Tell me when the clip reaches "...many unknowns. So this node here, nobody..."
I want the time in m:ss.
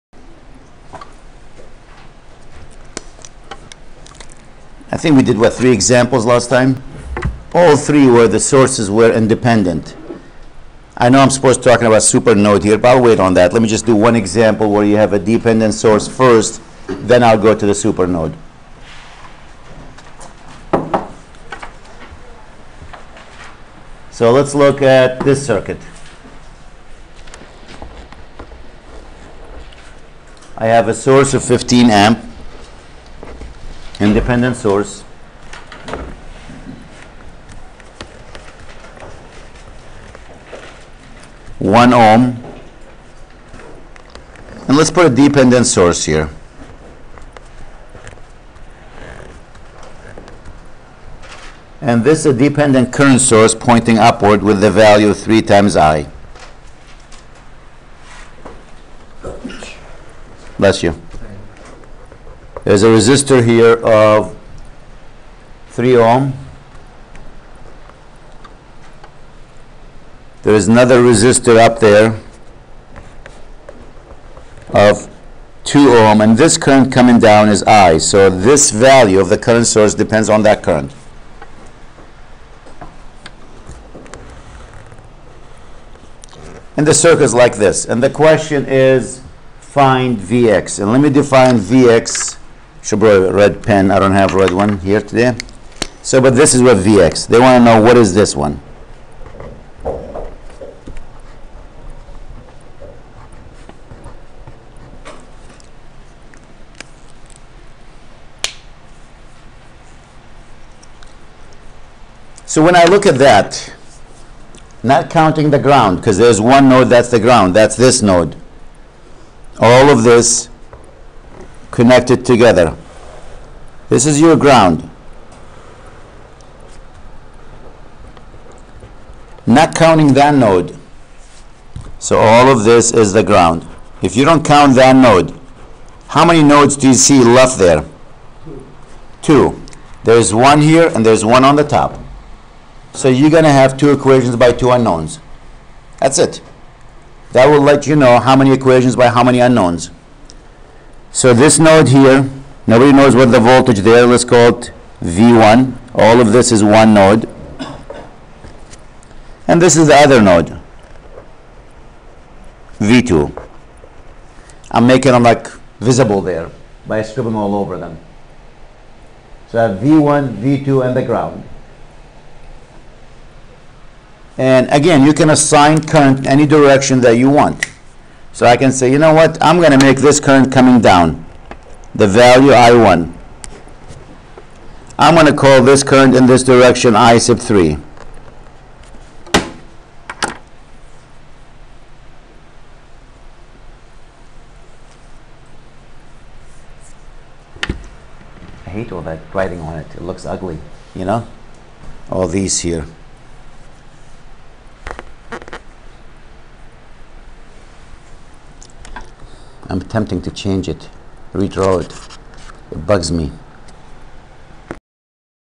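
2:29.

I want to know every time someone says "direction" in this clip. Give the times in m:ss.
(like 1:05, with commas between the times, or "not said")
2:56, 3:06.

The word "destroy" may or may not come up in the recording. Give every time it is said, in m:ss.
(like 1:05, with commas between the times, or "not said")
not said.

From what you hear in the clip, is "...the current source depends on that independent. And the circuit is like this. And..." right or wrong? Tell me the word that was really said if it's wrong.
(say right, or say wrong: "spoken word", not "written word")
wrong: "current", not "independent".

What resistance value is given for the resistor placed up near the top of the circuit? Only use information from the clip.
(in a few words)
2 ohm.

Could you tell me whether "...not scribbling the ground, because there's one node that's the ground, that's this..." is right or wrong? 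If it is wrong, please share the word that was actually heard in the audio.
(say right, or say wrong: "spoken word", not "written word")
wrong: "counting", not "scribbling".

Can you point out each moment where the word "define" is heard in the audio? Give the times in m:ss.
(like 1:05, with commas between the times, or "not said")
1:31.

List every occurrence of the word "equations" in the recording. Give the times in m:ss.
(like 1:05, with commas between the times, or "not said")
2:23, 2:28.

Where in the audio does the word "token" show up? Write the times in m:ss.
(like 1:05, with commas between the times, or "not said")
not said.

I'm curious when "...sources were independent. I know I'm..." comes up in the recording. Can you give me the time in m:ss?
0:08.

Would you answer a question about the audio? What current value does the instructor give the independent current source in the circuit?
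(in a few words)
15 amp.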